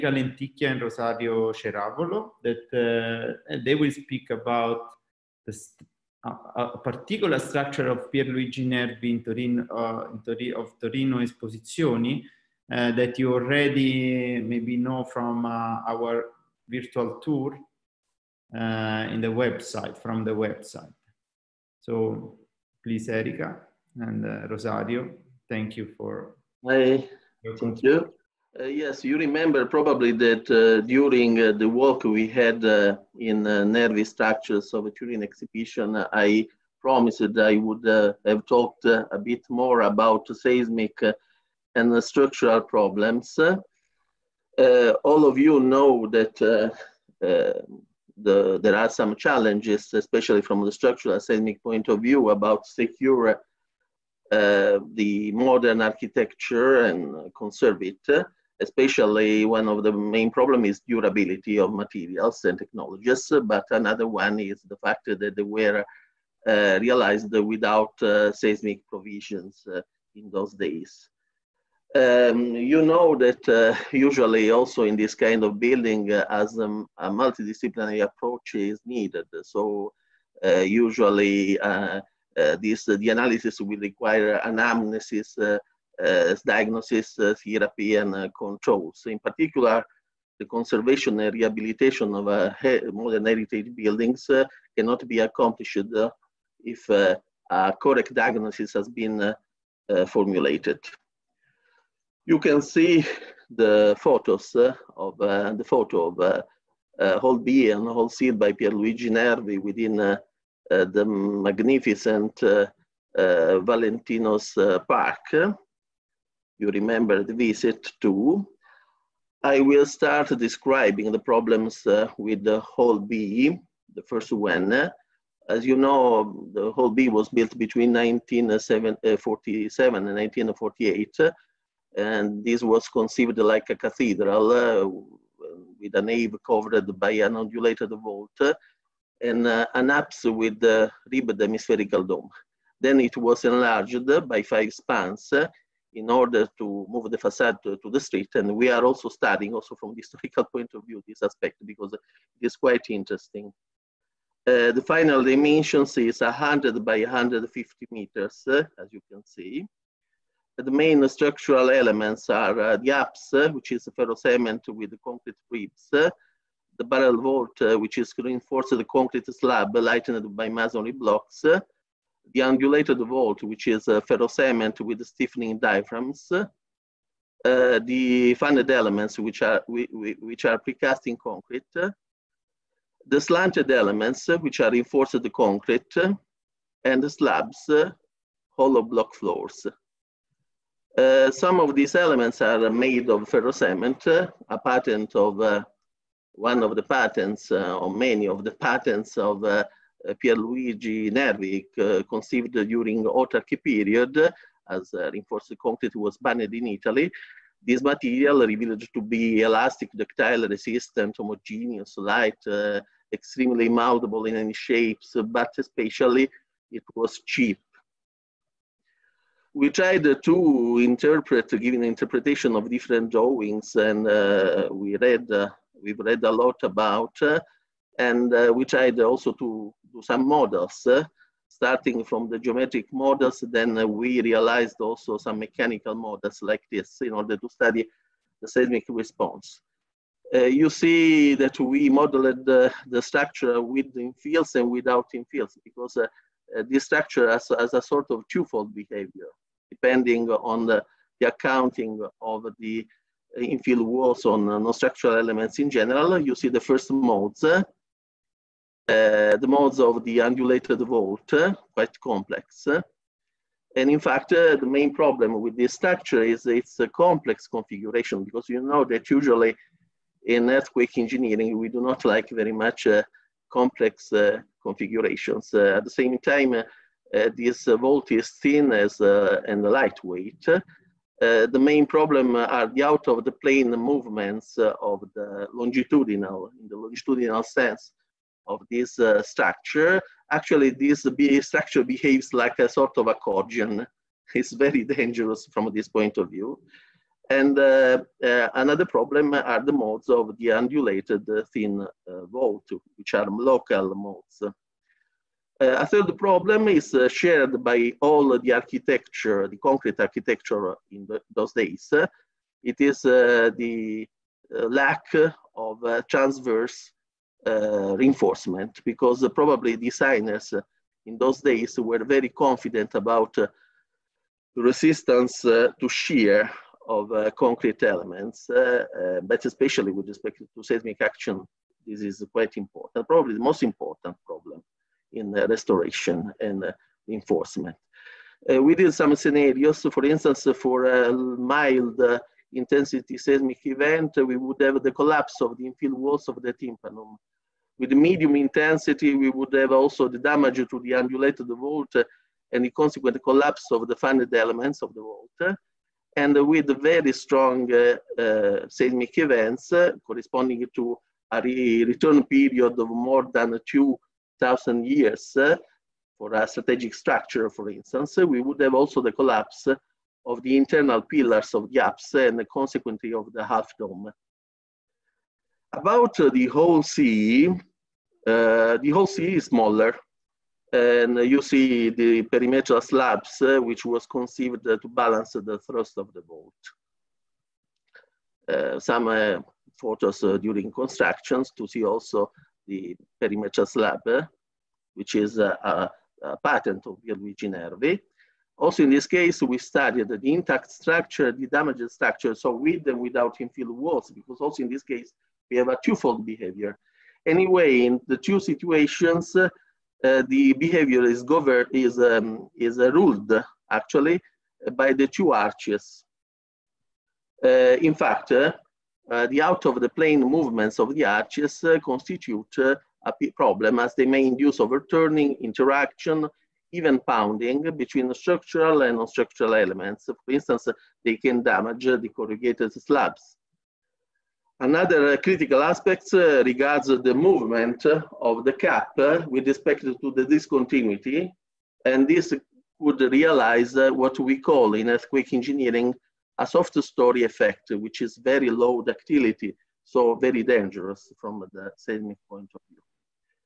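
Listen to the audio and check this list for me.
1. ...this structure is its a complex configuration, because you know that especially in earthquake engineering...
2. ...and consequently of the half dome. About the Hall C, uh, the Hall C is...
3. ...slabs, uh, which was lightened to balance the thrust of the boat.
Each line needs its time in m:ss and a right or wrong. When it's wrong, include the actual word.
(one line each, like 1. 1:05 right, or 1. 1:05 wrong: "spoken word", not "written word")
1. 4:25 wrong: "usually", not "especially"
2. 6:12 right
3. 6:22 wrong: "conceived", not "lightened".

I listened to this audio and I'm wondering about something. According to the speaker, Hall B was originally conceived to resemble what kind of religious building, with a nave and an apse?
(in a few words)
a cathedral.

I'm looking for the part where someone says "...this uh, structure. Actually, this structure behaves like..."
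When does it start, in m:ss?
4:48.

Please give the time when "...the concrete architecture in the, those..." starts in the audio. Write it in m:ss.
5:09.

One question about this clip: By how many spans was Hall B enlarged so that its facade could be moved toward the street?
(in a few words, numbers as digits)
5.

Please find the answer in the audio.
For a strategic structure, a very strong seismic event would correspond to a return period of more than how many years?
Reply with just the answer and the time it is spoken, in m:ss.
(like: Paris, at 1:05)
2,000, at 6:03.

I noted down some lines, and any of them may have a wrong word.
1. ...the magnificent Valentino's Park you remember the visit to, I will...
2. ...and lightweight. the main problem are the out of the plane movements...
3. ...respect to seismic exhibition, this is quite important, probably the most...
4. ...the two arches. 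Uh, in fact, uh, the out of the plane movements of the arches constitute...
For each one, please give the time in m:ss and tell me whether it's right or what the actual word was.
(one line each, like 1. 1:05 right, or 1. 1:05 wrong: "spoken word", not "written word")
1. 1:50 right
2. 4:38 right
3. 5:30 wrong: "action", not "exhibition"
4. 6:54 right.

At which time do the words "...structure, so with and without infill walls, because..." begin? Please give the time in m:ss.
6:41.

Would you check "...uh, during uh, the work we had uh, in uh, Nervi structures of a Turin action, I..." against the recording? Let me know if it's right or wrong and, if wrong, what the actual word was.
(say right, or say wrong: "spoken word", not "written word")
wrong: "exhibition", not "action".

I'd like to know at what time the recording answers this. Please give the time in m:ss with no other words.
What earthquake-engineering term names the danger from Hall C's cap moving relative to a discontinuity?
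7:26.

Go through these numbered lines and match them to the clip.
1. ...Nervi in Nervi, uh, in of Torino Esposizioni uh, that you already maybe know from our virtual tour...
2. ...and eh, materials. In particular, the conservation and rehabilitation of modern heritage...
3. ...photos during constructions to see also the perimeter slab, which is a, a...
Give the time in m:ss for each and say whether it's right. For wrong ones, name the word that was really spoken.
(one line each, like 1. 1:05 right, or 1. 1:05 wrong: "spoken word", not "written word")
1. 0:08 wrong: "Torino", not "Nervi"
2. 1:27 wrong: "controls", not "materials"
3. 6:29 right.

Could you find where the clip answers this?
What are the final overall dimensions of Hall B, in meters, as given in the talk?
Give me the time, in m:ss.
2:36.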